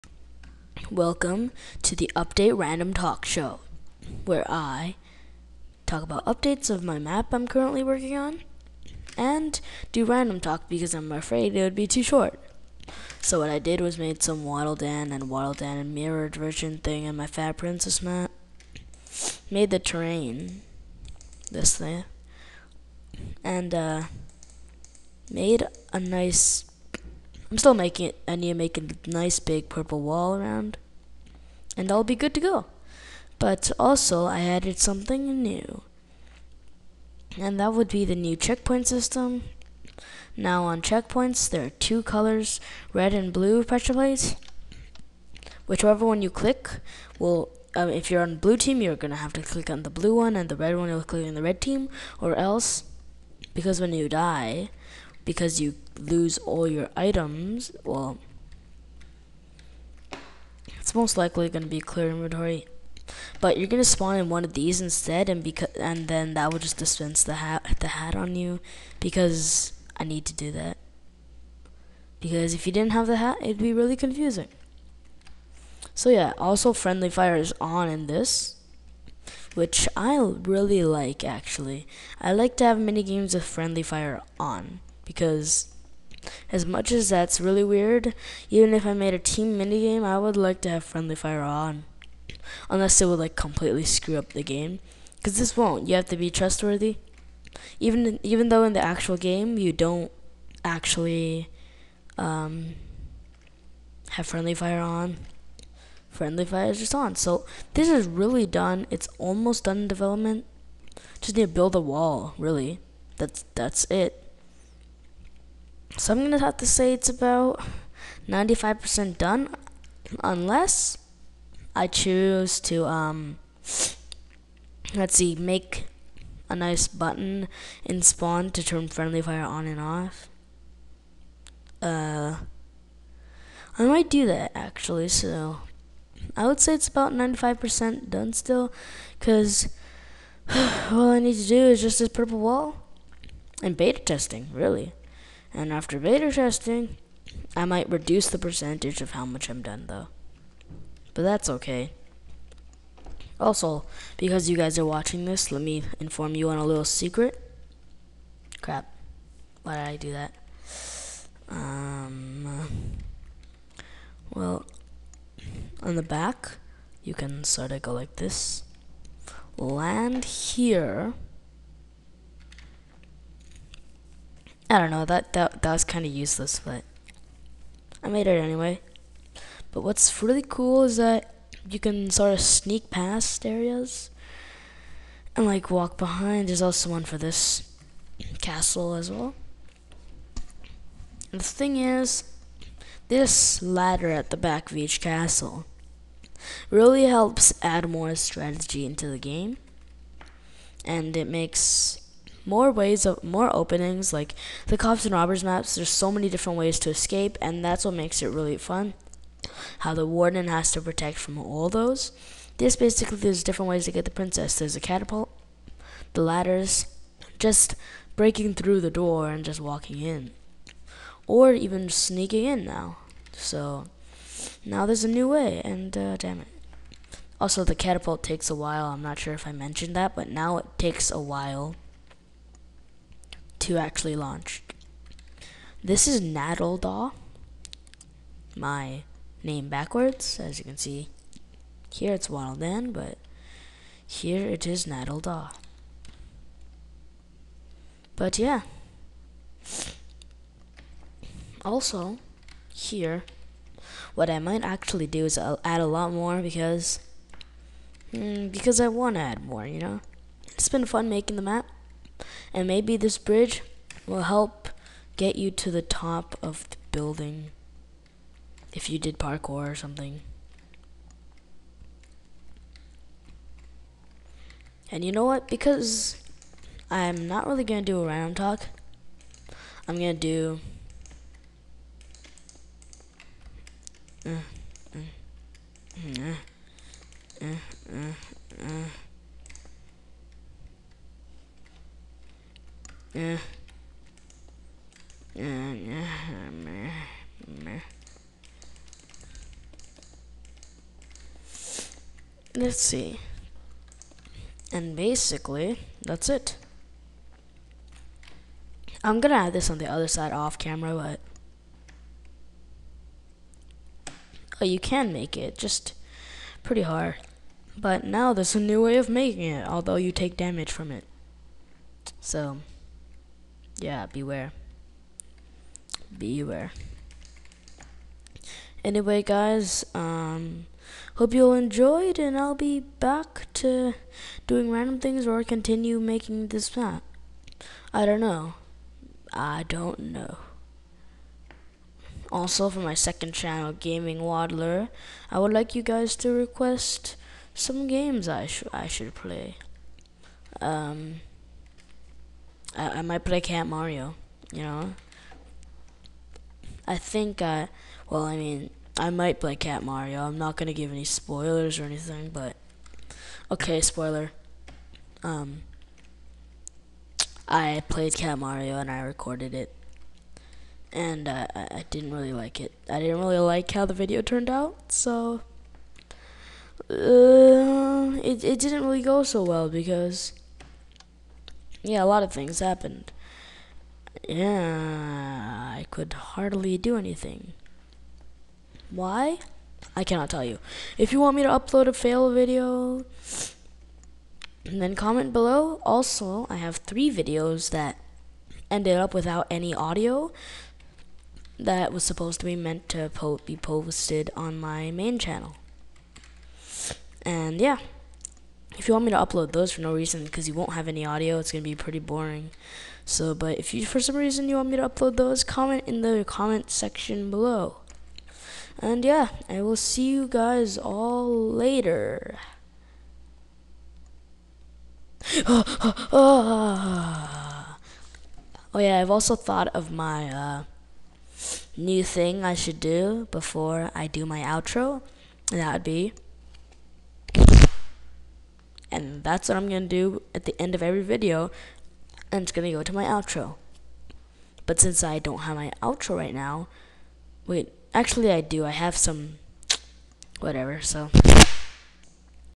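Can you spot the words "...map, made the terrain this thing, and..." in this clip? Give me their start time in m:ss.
0:18.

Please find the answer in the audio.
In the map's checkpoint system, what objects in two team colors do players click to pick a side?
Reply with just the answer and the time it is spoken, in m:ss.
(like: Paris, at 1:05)
pressure plates, at 0:43.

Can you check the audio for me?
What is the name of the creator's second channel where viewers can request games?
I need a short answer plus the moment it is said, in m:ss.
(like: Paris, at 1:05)
Gaming Waddler, at 5:43.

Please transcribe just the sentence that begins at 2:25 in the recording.
And after beta testing, I might reduce the percentage of how much I'm done though.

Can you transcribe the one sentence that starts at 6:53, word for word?
So, but if you for some reason you want me to upload those, comment in the comment section below.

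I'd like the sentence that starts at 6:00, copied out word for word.
I'm not gonna give any spoilers or anything, but okay, spoiler.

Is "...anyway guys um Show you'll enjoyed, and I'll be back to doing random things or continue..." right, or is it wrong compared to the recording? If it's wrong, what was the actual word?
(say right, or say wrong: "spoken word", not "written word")
wrong: "Hope", not "Show".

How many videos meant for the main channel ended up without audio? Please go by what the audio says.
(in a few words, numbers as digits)
3.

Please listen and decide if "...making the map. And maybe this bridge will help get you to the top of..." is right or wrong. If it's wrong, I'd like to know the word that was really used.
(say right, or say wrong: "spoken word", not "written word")
right.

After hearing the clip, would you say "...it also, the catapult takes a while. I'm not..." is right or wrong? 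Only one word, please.
right.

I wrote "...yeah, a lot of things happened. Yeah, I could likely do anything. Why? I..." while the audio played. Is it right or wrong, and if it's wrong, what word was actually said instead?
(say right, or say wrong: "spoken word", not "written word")
wrong: "hardly", not "likely".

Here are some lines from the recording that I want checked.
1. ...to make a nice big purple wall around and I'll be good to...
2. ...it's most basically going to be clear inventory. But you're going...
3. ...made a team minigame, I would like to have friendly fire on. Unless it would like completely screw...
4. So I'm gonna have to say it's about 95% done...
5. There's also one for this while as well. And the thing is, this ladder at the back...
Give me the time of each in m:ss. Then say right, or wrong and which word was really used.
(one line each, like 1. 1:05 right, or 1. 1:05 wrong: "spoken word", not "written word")
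1. 0:28 right
2. 1:00 wrong: "likely", not "basically"
3. 1:28 right
4. 1:55 right
5. 3:06 wrong: "castle", not "while".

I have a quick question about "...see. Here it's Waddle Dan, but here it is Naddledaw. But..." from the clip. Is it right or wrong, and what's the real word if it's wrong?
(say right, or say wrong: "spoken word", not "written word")
right.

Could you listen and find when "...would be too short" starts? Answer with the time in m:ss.
0:11.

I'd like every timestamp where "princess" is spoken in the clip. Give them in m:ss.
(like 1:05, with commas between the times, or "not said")
0:17, 3:34.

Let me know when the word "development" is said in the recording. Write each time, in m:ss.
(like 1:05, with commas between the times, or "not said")
1:49.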